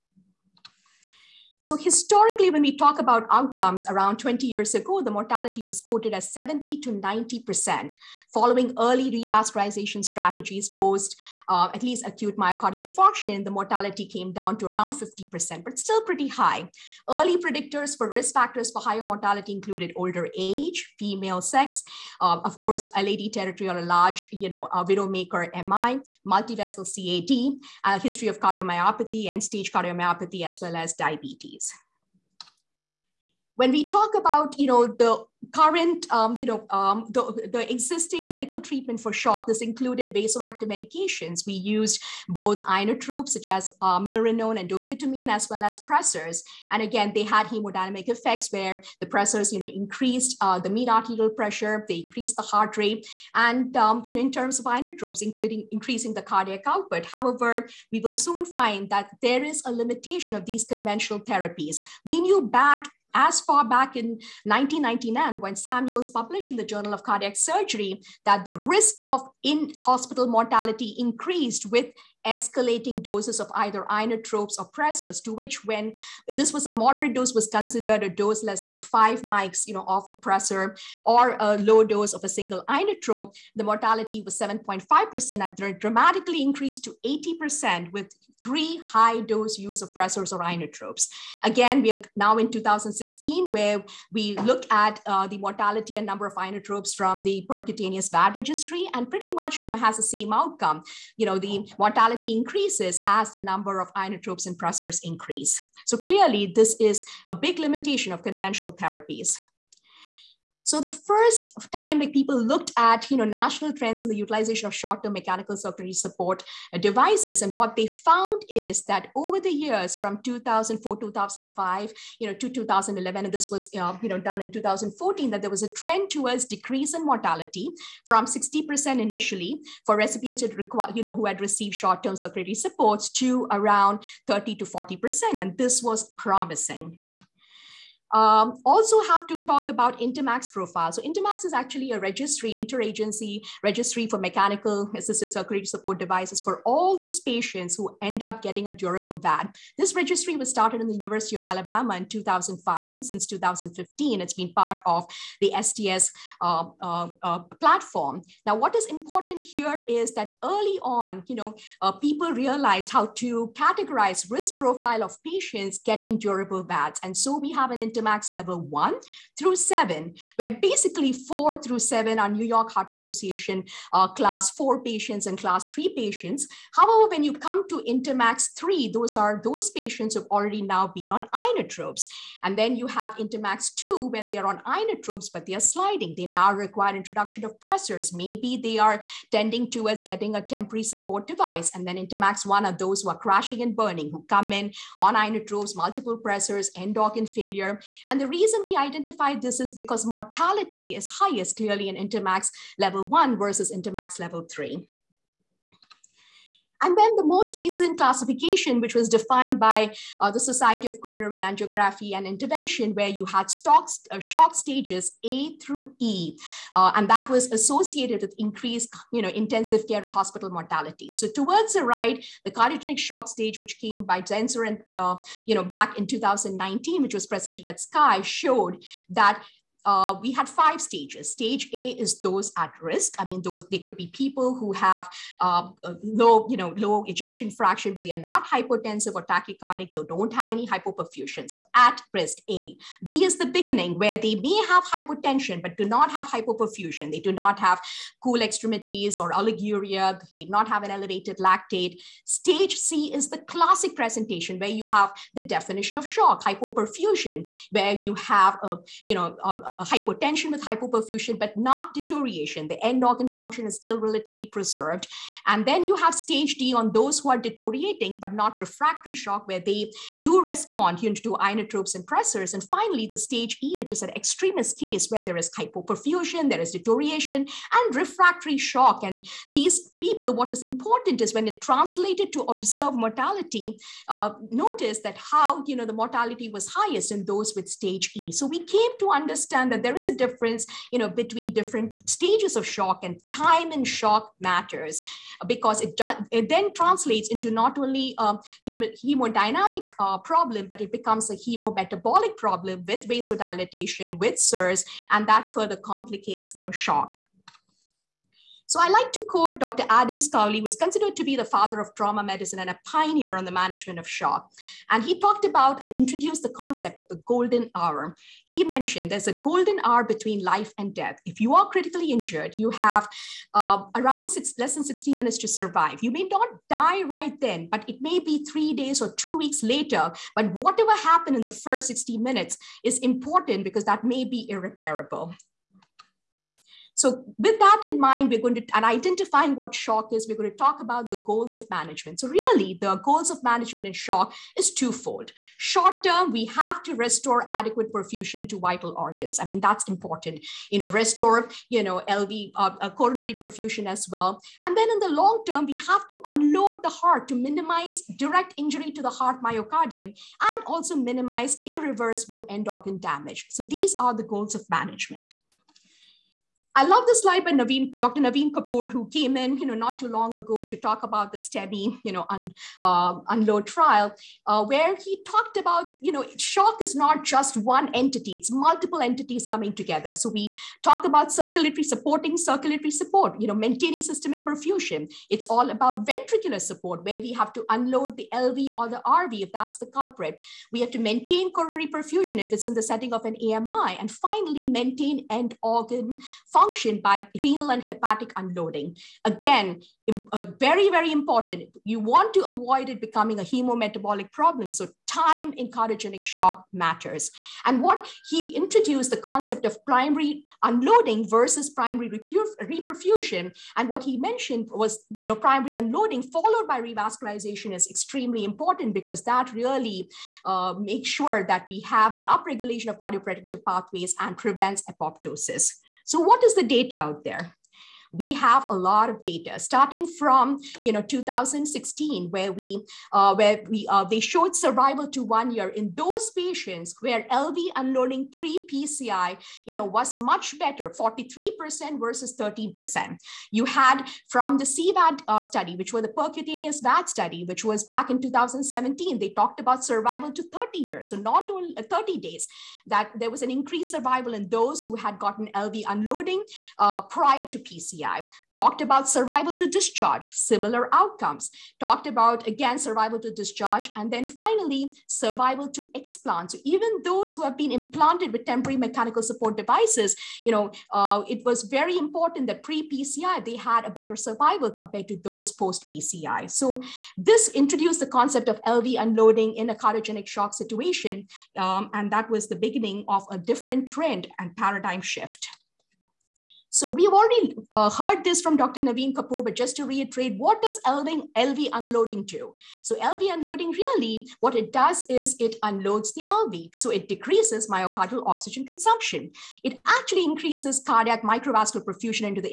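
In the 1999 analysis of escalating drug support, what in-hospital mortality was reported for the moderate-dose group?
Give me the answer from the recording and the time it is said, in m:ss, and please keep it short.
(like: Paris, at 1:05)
7.5%, at 1:24.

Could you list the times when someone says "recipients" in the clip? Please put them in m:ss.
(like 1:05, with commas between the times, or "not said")
2:09.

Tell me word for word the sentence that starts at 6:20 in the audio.
So we talk about circulatory supporting circulatory support, you know, maintaining systemic perfusion.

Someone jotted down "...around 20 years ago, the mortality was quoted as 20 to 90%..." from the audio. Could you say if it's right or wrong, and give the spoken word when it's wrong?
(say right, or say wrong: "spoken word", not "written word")
wrong: "70", not "20".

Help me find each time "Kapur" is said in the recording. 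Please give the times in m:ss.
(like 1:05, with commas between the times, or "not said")
6:08, 8:09.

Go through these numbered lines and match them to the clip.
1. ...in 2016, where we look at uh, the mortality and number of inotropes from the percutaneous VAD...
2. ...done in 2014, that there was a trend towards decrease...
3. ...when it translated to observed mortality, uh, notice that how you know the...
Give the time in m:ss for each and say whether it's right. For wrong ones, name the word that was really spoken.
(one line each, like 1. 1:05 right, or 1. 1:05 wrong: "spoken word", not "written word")
1. 1:32 right
2. 2:04 right
3. 4:41 right.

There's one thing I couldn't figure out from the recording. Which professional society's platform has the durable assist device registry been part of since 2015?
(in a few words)
STS.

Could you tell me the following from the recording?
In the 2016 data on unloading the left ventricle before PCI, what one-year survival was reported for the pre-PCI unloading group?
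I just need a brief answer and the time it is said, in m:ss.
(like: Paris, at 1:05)
43%, at 7:20.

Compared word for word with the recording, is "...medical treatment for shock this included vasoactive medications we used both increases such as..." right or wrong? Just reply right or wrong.
wrong.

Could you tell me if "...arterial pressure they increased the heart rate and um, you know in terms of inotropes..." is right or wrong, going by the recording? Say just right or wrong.
right.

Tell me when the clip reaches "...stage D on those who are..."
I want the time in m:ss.
4:26.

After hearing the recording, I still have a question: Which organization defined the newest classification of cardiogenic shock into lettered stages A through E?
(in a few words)
Society of Coronary Angiography and Intervention.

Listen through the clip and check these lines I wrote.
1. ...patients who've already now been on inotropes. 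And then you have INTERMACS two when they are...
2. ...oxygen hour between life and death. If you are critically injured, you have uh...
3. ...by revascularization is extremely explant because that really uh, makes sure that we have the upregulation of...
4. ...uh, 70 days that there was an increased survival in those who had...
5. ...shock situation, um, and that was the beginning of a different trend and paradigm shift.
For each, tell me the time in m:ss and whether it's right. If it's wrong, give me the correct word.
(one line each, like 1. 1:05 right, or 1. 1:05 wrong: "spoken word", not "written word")
1. 2:59 right
2. 5:19 wrong: "golden", not "oxygen"
3. 6:56 wrong: "important", not "explant"
4. 7:31 wrong: "30", not "70"
5. 8:00 right.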